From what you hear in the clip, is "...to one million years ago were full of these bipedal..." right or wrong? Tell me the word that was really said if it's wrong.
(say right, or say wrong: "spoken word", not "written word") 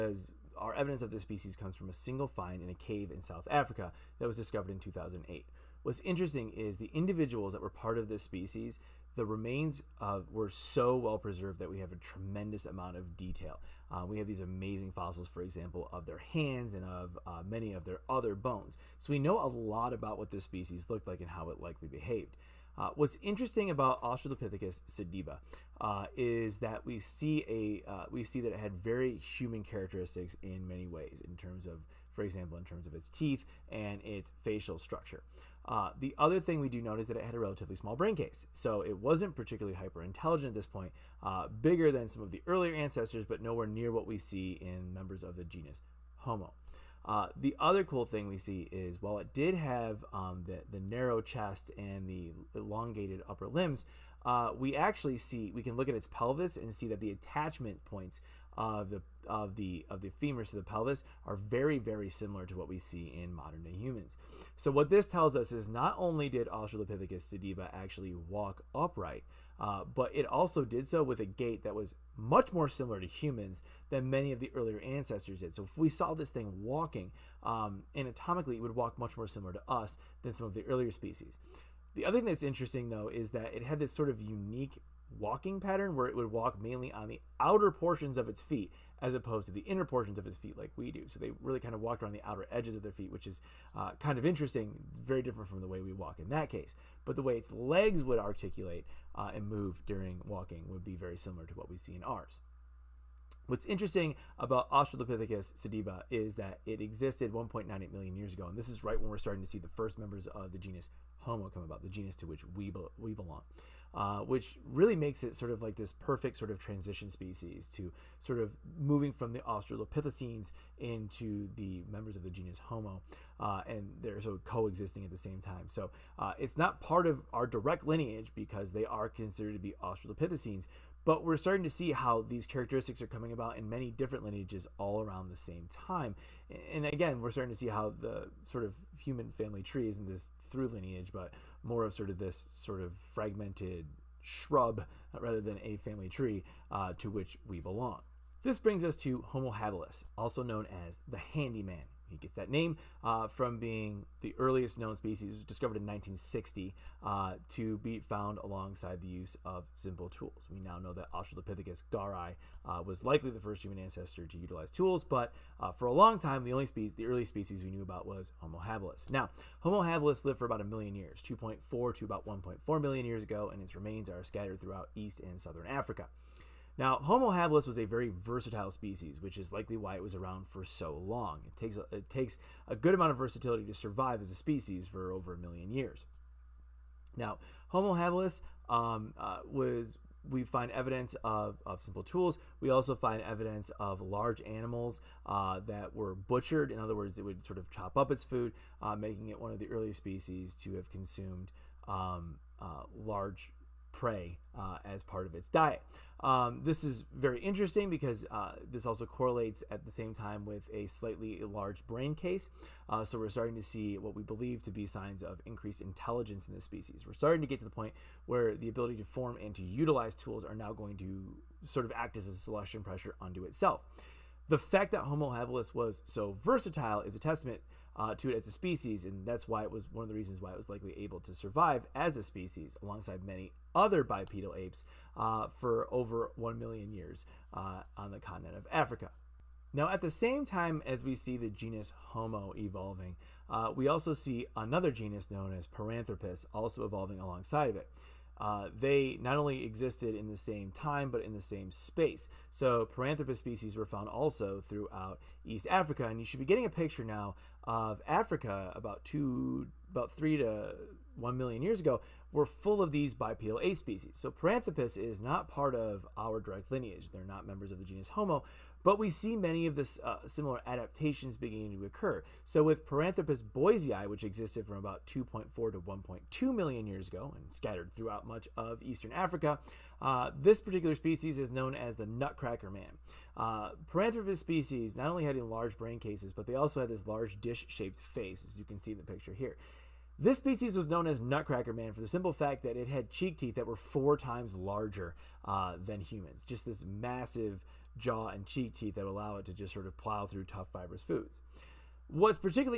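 right.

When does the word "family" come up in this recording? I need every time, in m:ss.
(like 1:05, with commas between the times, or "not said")
2:19, 2:25.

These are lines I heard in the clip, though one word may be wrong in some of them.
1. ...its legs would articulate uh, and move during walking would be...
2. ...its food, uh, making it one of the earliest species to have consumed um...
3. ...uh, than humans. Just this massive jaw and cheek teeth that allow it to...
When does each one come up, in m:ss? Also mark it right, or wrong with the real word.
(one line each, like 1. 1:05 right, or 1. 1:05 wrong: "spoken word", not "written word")
1. 1:37 right
2. 3:18 right
3. 4:55 right.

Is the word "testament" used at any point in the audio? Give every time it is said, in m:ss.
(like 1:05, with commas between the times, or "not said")
3:47.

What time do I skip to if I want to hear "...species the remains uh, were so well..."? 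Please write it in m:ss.
0:08.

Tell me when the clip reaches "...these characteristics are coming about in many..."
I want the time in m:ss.
2:12.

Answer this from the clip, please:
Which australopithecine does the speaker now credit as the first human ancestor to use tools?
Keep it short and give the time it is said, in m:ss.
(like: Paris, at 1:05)
Australopithecus garhi, at 2:41.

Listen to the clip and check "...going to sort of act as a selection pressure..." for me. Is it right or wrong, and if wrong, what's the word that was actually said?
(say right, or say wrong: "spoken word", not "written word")
right.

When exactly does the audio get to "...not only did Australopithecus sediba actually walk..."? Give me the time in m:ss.
1:05.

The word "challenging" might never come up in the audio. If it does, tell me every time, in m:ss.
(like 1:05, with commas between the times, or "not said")
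not said.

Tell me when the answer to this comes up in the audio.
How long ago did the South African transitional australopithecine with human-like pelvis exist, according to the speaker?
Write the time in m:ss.
1:47.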